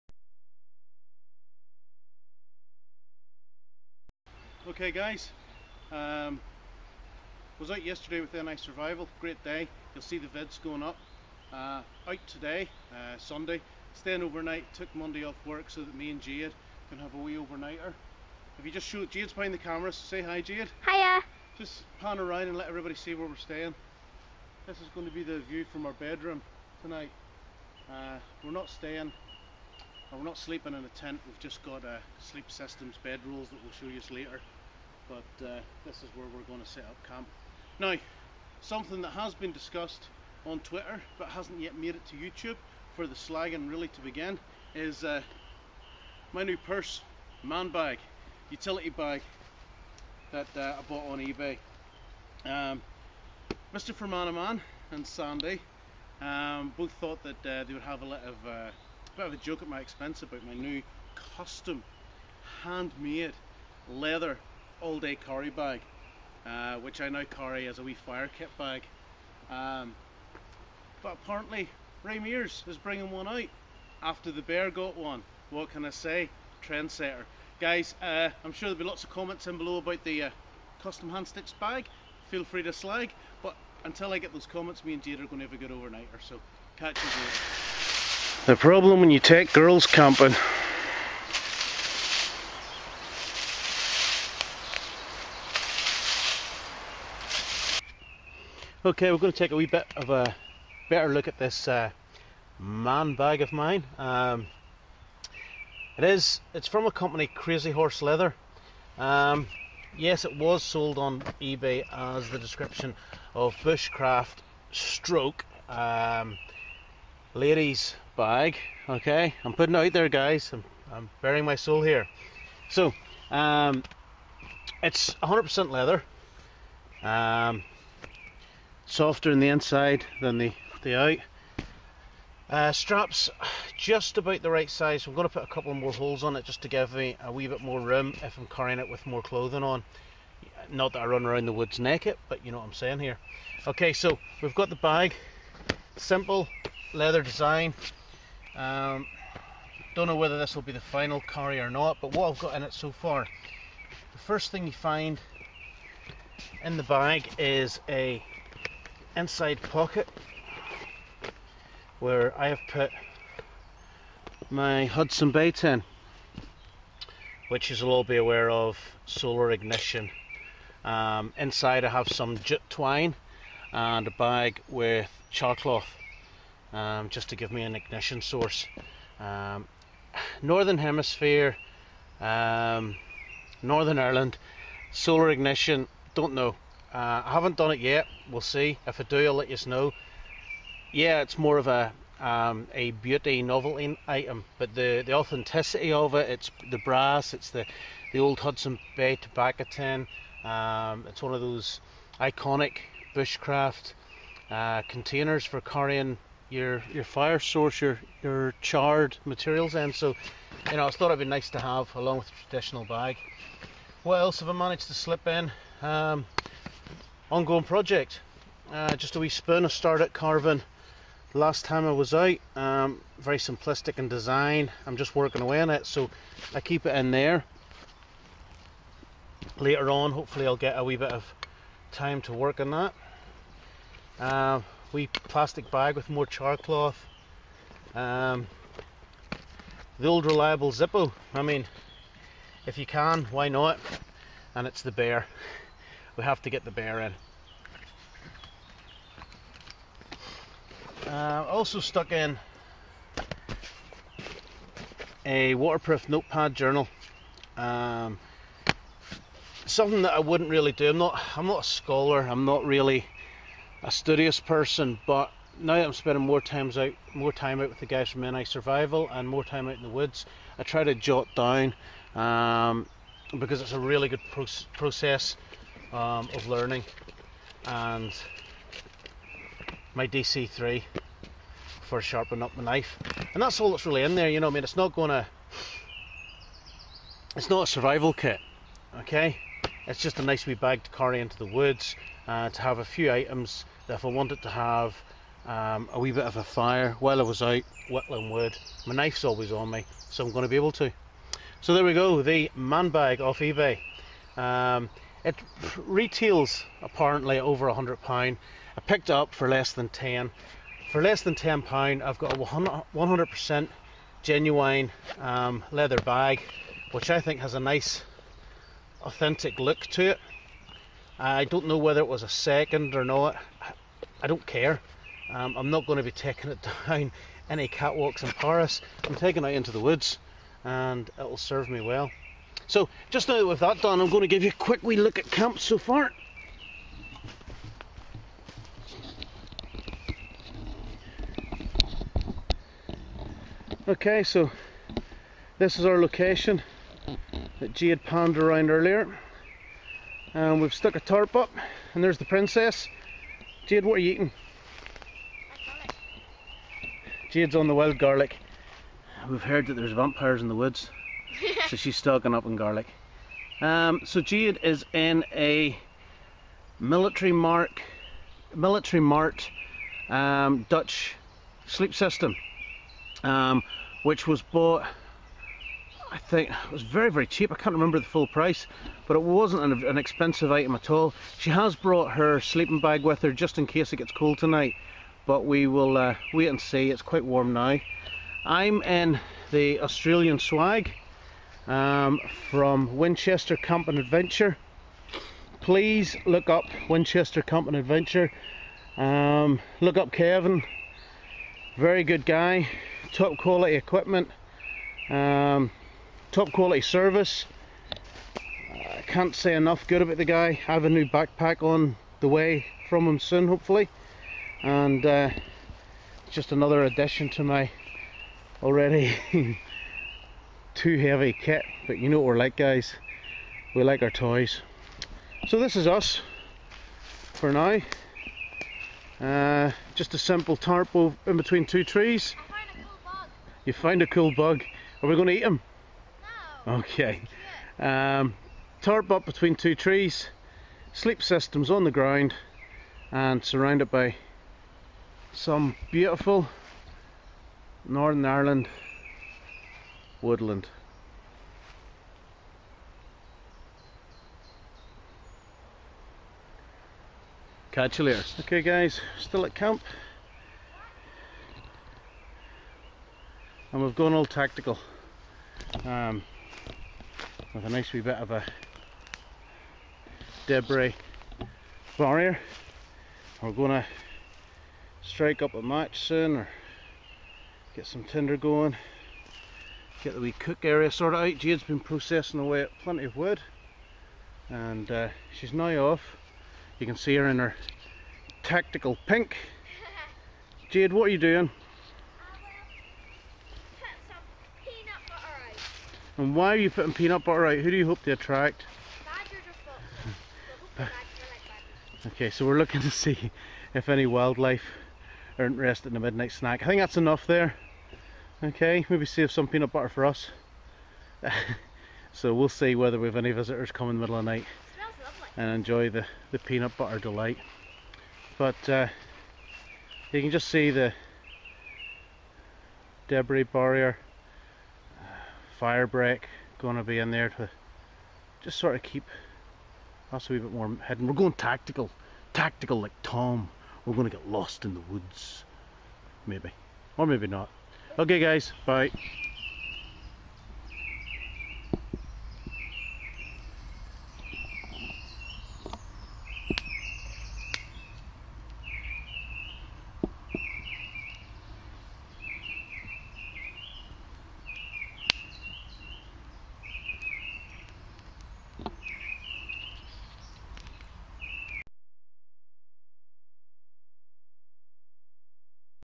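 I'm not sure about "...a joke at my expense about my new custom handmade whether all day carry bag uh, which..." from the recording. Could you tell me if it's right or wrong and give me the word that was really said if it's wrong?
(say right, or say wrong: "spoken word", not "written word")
wrong: "leather", not "whether".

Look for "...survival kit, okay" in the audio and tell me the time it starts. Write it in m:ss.
4:47.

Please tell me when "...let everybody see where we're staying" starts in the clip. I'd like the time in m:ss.
0:22.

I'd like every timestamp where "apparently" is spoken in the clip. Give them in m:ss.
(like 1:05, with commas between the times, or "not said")
1:11, 5:06.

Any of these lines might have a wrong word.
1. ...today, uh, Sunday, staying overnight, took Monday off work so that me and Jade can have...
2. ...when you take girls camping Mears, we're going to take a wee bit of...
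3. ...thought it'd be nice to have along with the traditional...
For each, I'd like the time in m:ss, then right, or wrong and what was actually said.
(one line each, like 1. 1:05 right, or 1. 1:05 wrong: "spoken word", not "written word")
1. 0:12 right
2. 1:29 wrong: "Okay", not "Mears"
3. 3:30 right.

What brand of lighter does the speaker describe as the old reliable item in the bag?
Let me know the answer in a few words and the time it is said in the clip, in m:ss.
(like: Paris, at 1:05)
Zippo, at 4:00.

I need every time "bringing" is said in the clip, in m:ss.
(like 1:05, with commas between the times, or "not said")
1:12.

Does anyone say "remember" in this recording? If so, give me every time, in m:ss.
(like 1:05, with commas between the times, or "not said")
6:17.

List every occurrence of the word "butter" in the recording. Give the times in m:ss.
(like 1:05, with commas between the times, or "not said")
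8:17, 8:29, 8:36.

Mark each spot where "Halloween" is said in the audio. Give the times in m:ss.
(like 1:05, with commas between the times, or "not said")
not said.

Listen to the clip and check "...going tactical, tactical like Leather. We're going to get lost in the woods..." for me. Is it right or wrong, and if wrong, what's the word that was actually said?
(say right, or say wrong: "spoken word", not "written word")
wrong: "Tom", not "Leather".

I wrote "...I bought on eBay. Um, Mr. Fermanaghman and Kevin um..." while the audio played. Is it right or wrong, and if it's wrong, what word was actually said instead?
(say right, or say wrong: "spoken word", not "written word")
wrong: "Sandy", not "Kevin".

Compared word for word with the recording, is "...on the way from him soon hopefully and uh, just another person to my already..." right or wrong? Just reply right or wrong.
wrong.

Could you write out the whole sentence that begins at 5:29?
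I'm taking it into the woods and it'll serve me well.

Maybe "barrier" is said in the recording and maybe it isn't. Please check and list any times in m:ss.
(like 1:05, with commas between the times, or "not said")
7:51, 8:43.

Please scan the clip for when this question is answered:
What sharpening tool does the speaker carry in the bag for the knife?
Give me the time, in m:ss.
4:40.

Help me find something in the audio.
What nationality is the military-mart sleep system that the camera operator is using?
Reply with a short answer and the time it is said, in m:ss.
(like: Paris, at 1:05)
Dutch, at 6:10.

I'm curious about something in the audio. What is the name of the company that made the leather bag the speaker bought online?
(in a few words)
Crazy Horse Leather.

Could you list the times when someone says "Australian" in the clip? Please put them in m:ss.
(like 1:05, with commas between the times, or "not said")
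6:29.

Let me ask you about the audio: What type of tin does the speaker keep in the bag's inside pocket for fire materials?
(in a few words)
Hudson Bay tin.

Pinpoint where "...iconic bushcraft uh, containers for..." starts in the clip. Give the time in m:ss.
3:22.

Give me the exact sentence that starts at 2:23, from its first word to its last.
Okay, so we've got the bag.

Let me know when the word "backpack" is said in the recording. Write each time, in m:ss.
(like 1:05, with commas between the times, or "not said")
6:51.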